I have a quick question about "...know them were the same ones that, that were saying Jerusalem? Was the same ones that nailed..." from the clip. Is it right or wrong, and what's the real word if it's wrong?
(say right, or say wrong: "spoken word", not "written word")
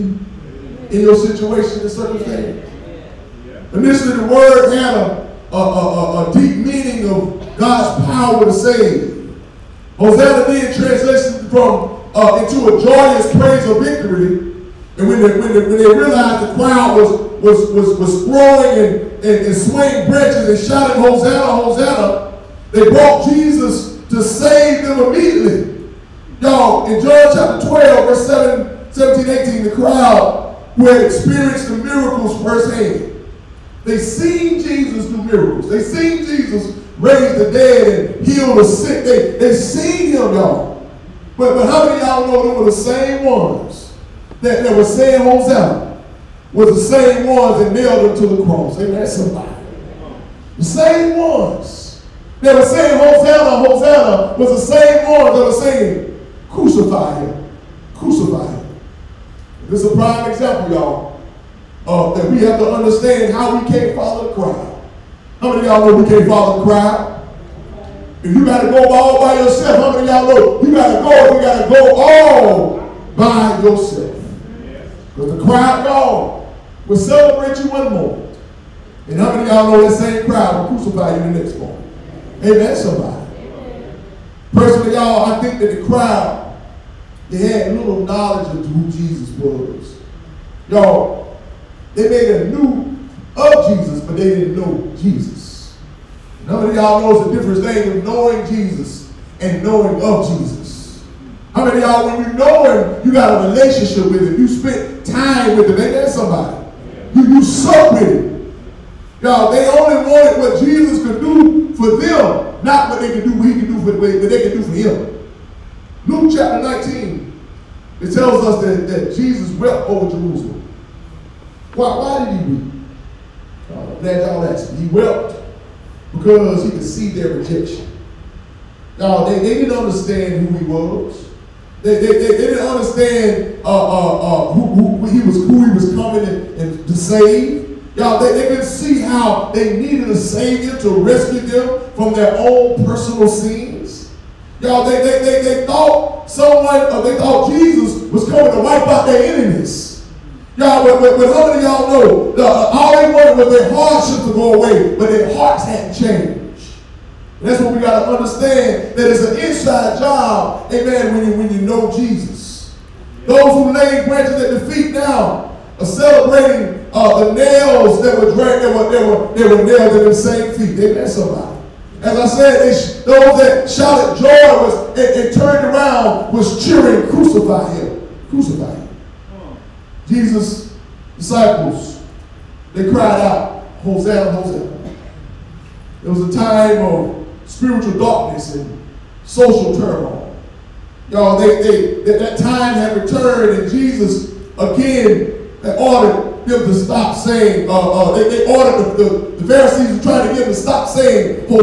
wrong: "Hosanna", not "Jerusalem".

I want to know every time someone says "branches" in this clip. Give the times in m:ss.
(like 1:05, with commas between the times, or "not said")
0:20, 2:44.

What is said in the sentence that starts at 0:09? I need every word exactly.
Hosanna being translated from uh, into a joyous praise of victory.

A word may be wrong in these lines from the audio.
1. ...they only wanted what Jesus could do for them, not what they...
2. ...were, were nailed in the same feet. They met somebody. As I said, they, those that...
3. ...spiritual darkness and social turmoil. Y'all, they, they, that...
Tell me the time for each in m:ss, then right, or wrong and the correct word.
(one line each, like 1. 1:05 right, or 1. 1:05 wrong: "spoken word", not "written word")
1. 1:49 right
2. 2:49 right
3. 3:07 right.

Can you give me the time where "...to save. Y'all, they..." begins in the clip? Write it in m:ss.
2:16.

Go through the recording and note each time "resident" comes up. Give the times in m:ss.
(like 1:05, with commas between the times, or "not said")
not said.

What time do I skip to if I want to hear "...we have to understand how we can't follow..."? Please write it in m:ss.
1:02.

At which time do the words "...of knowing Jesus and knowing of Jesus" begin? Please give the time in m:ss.
1:37.